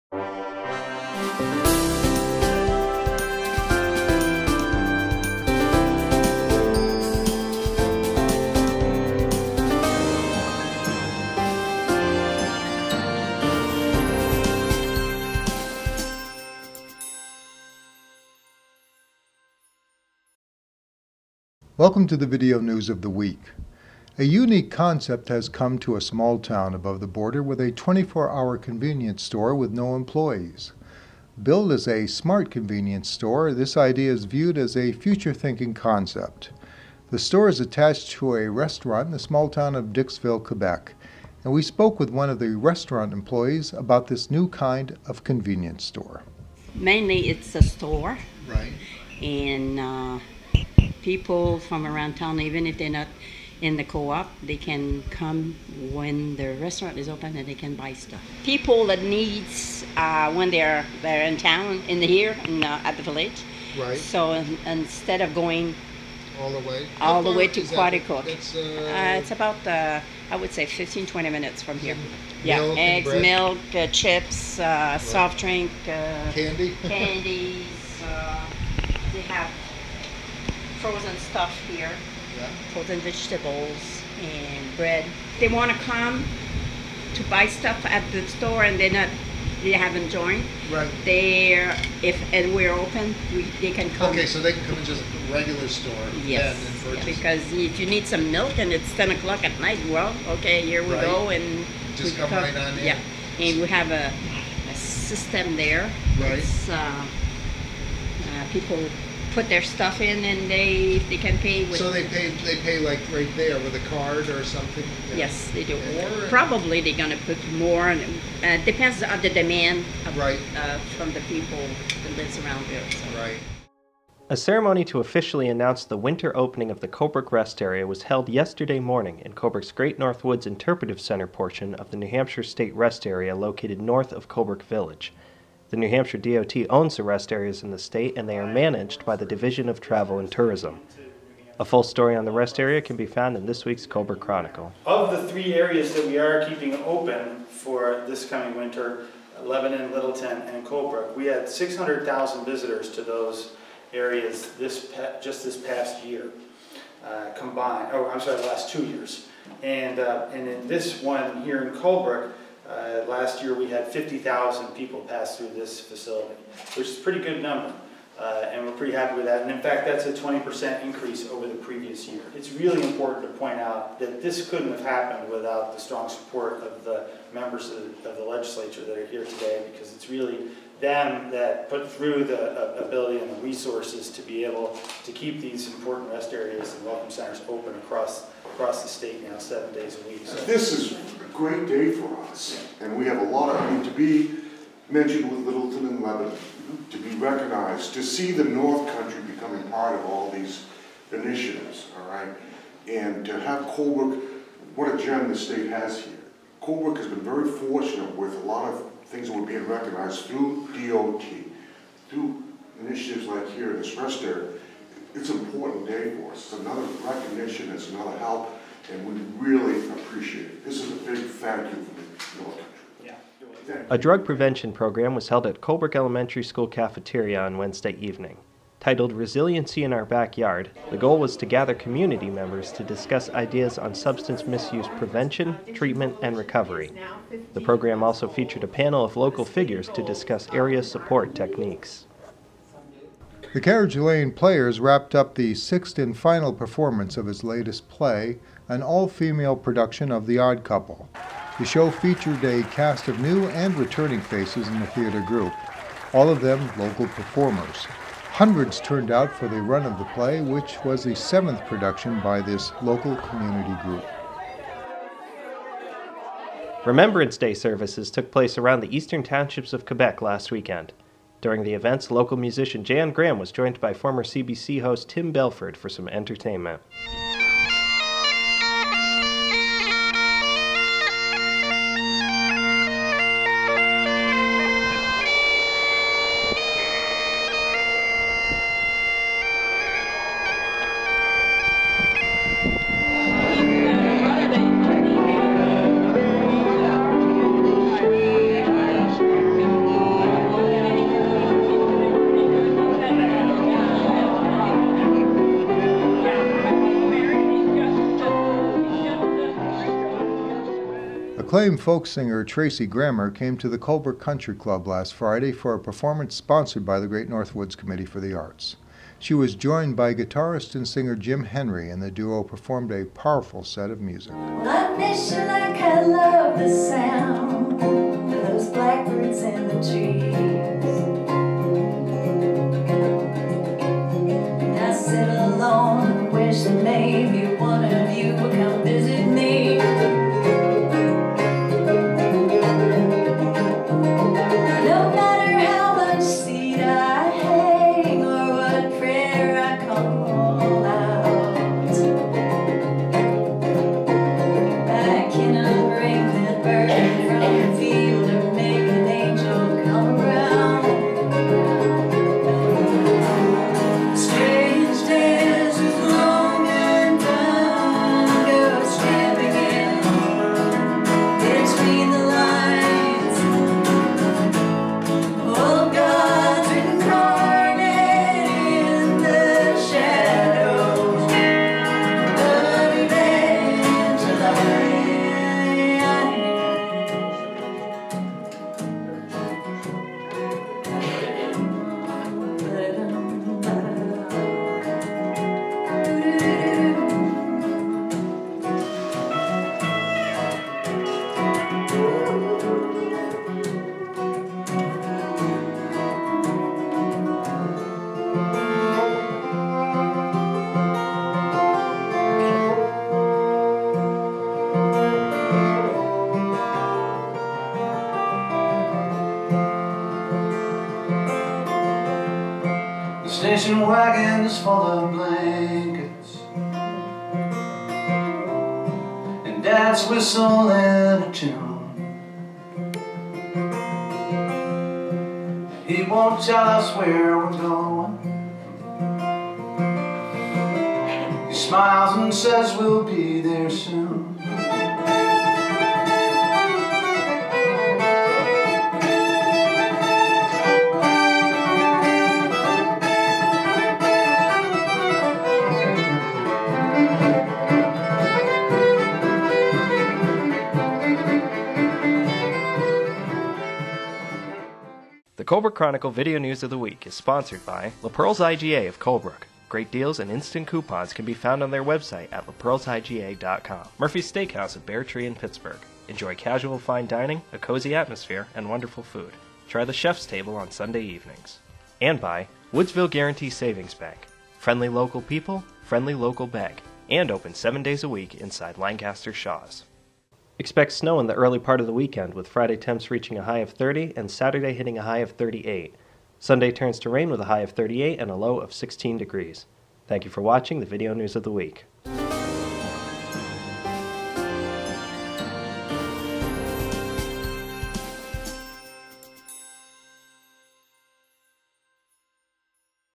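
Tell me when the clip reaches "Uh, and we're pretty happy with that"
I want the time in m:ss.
2:48.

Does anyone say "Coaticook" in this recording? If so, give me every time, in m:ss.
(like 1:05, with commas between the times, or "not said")
1:07.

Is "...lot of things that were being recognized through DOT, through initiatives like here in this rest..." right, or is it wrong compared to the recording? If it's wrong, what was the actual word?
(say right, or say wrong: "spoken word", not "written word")
right.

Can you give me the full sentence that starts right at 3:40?
This is a big thank you for the a drug prevention program was held at Colebrook Elementary School cafeteria on Wednesday evening.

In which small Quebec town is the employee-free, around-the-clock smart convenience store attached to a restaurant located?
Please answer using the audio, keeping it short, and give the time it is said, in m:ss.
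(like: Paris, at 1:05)
Dixville, at 0:39.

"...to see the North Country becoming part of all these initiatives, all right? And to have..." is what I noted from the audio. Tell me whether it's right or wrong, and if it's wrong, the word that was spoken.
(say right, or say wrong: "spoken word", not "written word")
right.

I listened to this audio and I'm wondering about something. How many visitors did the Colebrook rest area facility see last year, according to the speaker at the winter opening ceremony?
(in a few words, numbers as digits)
50,000.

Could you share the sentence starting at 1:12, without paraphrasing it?
yeah milk eggs milk chips right.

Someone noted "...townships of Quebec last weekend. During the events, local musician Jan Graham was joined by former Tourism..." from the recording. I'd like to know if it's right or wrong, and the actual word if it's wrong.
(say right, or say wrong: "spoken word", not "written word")
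wrong: "CBC", not "Tourism".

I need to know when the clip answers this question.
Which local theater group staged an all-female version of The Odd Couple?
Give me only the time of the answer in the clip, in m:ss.
4:03.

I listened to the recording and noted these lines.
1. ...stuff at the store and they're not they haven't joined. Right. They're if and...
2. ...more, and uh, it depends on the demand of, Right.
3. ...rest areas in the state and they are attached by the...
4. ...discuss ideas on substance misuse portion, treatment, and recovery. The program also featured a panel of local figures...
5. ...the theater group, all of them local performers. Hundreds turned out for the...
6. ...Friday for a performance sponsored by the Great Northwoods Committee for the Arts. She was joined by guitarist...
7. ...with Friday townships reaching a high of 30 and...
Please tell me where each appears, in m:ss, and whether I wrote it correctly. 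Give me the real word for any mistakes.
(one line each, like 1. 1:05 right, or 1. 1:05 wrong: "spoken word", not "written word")
1. 1:27 right
2. 1:57 right
3. 2:17 wrong: "managed", not "attached"
4. 3:52 wrong: "prevention", not "portion"
5. 4:14 right
6. 5:15 right
7. 8:12 wrong: "temps", not "townships".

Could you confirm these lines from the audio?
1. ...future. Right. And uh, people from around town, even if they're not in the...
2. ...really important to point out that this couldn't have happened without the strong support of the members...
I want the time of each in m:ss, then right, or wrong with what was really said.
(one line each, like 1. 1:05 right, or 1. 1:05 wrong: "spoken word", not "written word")
1. 0:47 wrong: "store", not "future"
2. 2:52 right.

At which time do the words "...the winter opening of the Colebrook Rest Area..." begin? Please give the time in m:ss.
2:05.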